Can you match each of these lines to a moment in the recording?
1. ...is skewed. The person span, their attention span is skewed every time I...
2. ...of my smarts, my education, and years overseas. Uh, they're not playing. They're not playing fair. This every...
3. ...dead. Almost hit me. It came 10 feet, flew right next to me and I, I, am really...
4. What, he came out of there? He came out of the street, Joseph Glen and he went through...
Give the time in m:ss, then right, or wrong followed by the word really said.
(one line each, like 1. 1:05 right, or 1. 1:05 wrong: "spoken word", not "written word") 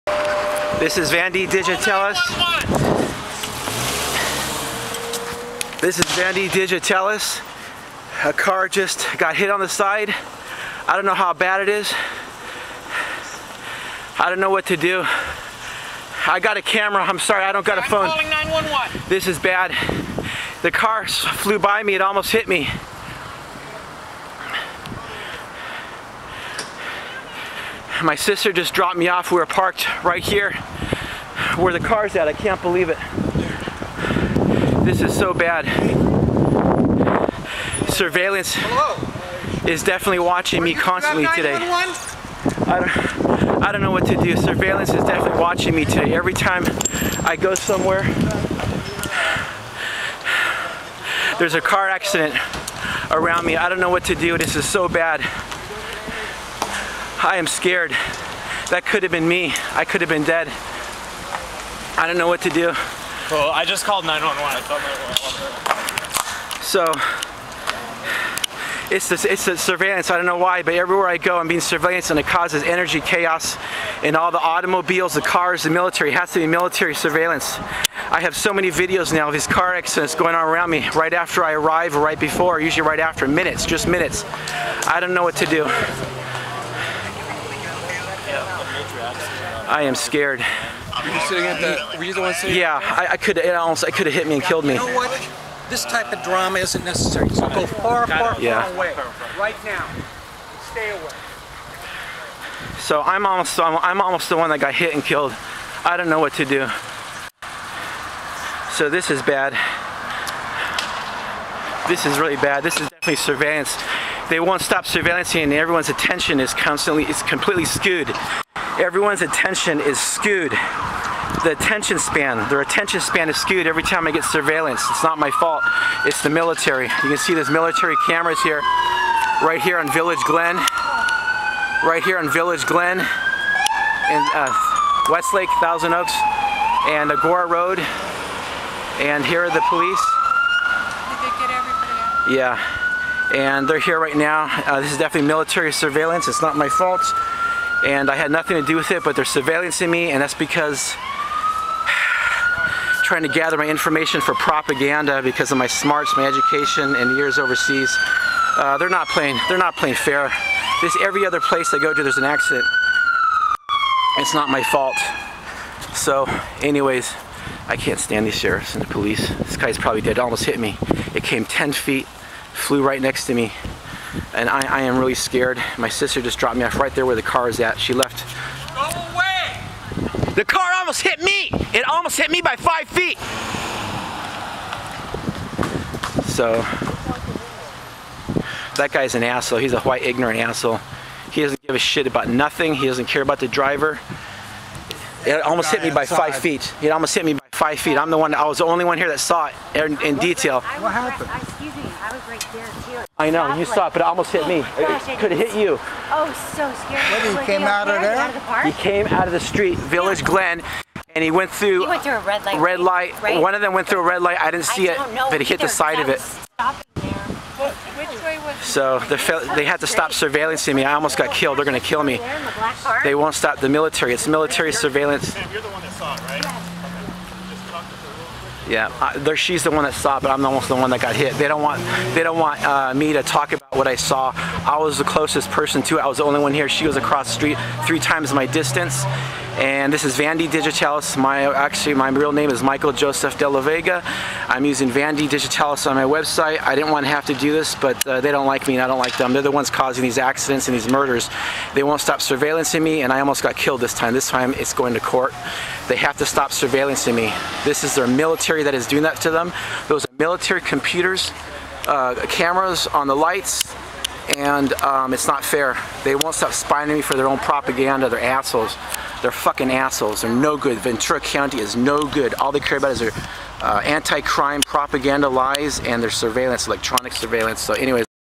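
1. 1:59 wrong: "attention", not "person"
2. 2:35 right
3. 2:50 right
4. 3:27 wrong: "Village", not "Joseph".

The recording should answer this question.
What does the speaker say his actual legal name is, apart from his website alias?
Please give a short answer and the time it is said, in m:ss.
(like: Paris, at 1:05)
Michael Joseph De La Vega, at 4:02.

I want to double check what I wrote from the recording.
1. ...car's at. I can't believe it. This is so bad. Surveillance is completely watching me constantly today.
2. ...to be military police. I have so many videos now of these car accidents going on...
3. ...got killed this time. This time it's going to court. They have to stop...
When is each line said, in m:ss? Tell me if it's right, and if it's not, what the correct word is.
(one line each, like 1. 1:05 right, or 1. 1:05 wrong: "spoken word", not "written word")
1. 0:31 wrong: "definitely", not "completely"
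2. 1:16 wrong: "surveillance", not "police"
3. 4:13 right.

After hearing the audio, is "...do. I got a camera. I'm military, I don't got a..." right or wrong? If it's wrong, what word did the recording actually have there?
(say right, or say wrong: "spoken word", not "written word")
wrong: "sorry", not "military".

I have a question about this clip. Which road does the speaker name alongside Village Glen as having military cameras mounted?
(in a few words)
Agoura Road.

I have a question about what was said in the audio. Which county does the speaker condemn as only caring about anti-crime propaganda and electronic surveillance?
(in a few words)
Ventura County.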